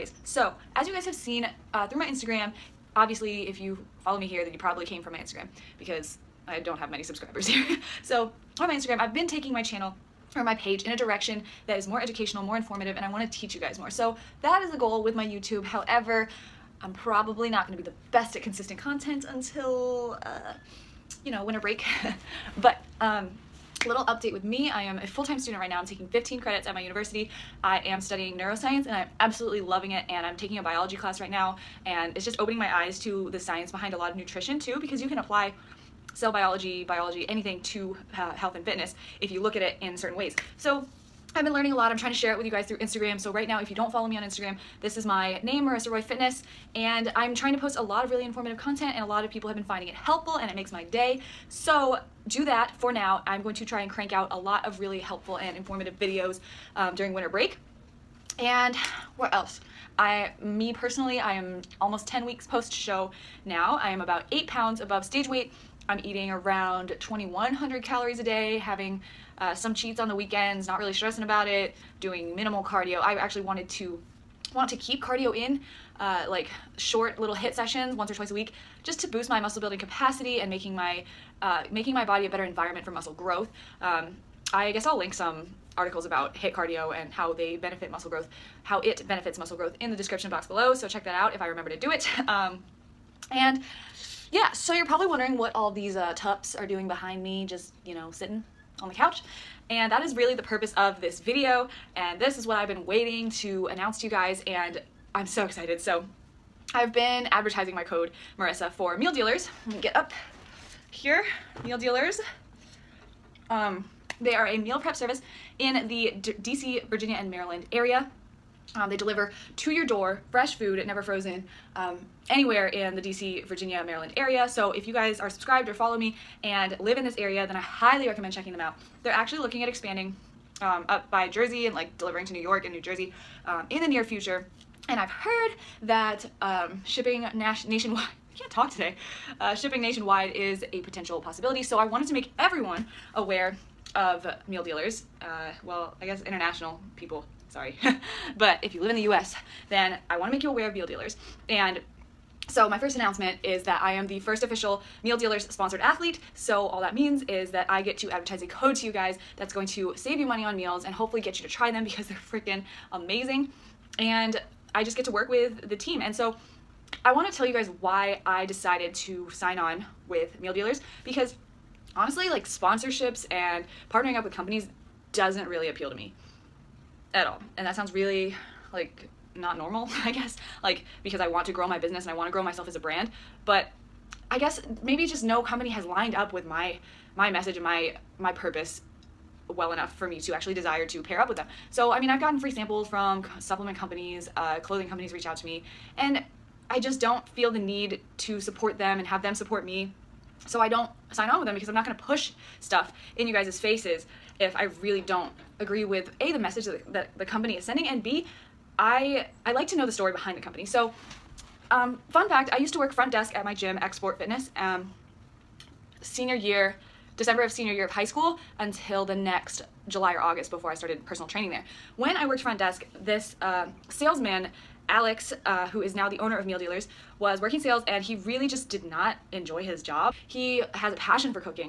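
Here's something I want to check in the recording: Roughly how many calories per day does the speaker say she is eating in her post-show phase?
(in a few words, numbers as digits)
2,100.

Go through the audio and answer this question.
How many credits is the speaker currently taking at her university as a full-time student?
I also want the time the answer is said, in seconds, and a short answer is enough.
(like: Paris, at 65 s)
15, at 26 s.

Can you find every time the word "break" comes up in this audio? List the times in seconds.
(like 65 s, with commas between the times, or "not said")
21 s, 57 s.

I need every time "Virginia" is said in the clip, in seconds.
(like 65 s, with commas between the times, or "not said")
116 s, 123 s.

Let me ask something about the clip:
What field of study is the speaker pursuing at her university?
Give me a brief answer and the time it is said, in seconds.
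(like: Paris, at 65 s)
Neuroscience, at 28 s.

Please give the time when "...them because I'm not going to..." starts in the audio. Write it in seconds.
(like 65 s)
201 s.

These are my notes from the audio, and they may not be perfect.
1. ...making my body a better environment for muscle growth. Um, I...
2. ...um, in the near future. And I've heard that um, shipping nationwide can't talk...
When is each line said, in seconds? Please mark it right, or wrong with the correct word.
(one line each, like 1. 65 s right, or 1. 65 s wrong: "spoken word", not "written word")
1. 81 s right
2. 133 s right.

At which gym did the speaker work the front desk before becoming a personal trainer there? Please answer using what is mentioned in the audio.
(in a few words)
Xsport Fitness.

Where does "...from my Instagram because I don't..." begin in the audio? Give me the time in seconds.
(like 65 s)
5 s.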